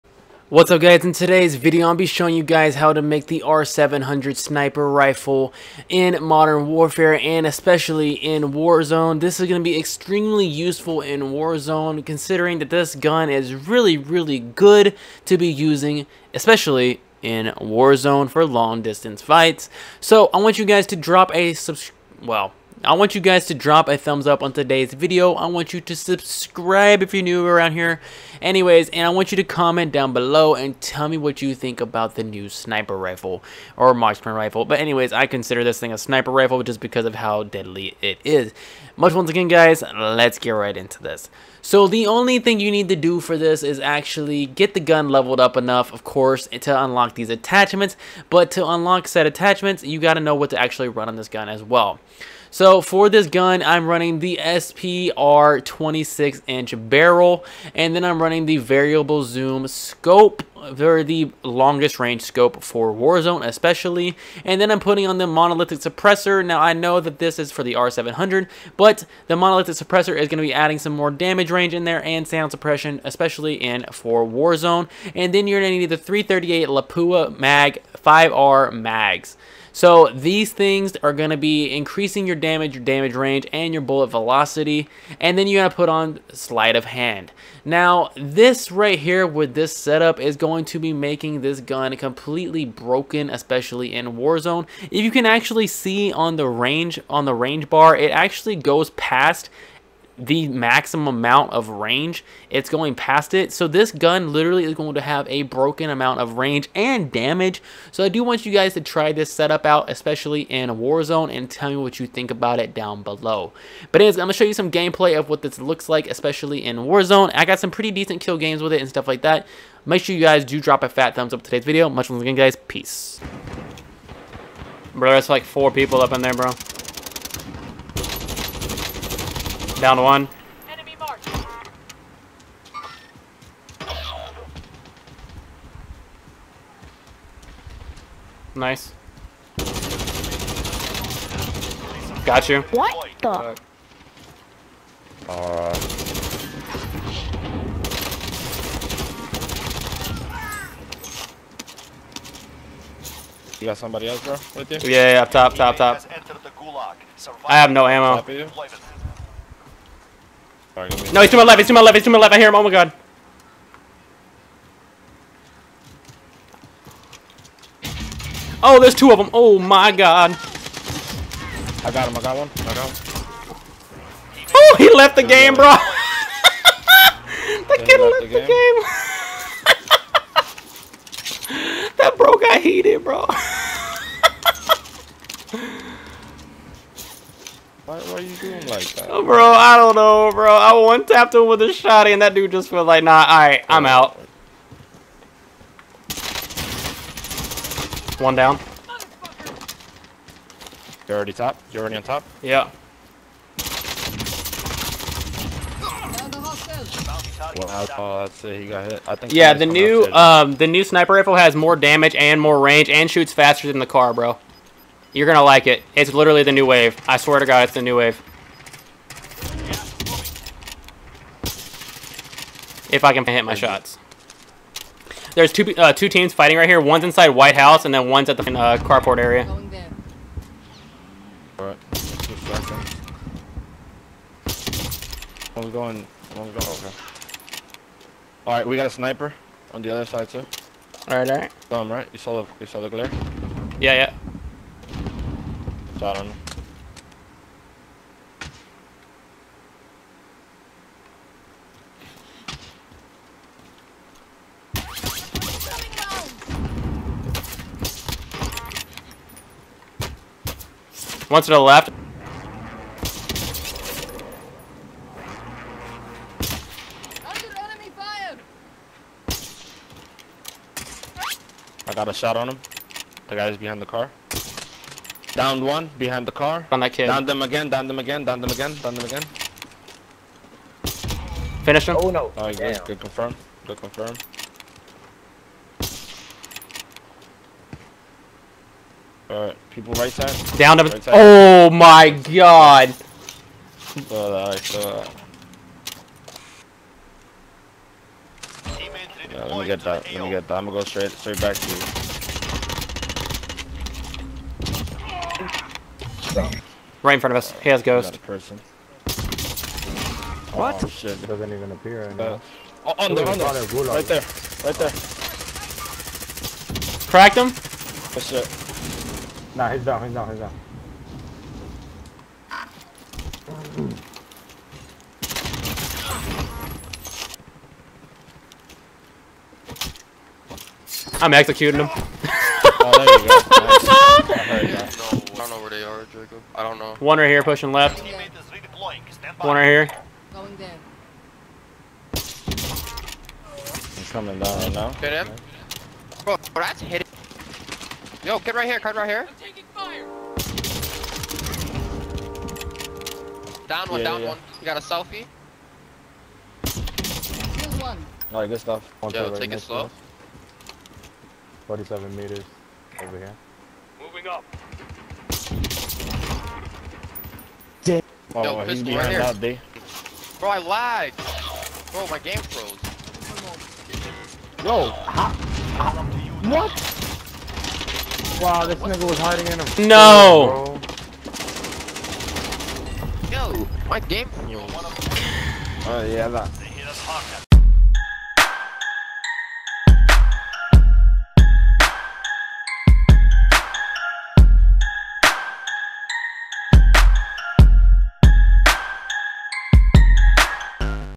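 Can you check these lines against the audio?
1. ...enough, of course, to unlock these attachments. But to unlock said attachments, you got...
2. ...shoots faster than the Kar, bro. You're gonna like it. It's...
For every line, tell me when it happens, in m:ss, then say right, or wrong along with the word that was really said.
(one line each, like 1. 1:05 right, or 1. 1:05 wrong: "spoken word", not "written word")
1. 0:45 right
2. 3:33 right.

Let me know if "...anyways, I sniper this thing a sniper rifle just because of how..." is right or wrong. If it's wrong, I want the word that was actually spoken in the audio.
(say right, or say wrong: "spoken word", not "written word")
wrong: "consider", not "sniper".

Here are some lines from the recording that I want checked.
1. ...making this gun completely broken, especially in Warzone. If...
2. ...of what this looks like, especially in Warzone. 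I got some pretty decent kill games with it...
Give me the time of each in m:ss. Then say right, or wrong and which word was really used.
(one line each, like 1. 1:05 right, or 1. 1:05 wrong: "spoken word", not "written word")
1. 1:30 right
2. 1:55 right.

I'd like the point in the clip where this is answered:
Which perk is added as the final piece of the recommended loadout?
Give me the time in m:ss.
1:26.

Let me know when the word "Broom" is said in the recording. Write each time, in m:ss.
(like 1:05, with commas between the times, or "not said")
not said.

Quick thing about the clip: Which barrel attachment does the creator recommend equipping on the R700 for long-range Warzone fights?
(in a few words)
SPR 26 inch barrel.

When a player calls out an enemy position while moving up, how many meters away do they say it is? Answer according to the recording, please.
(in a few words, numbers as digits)
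47.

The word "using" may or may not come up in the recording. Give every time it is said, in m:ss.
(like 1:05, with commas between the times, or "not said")
0:15.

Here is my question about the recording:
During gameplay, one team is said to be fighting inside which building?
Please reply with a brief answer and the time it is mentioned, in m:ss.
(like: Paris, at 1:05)
White House, at 3:47.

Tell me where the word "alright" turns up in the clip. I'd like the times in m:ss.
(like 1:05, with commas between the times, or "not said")
2:25, 3:13, 3:51, 4:49, 5:58.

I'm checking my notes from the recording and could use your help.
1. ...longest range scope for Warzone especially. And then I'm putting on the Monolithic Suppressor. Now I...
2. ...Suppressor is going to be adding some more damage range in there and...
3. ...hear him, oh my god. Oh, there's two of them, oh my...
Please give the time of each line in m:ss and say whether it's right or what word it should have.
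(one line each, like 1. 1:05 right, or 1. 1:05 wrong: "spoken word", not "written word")
1. 1:01 right
2. 1:09 right
3. 2:42 right.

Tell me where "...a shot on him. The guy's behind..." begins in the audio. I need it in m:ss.
4:32.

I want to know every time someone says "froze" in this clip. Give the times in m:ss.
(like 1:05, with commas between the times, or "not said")
6:12, 6:24.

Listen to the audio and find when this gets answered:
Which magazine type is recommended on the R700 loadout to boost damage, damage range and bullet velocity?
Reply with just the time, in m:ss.
1:15.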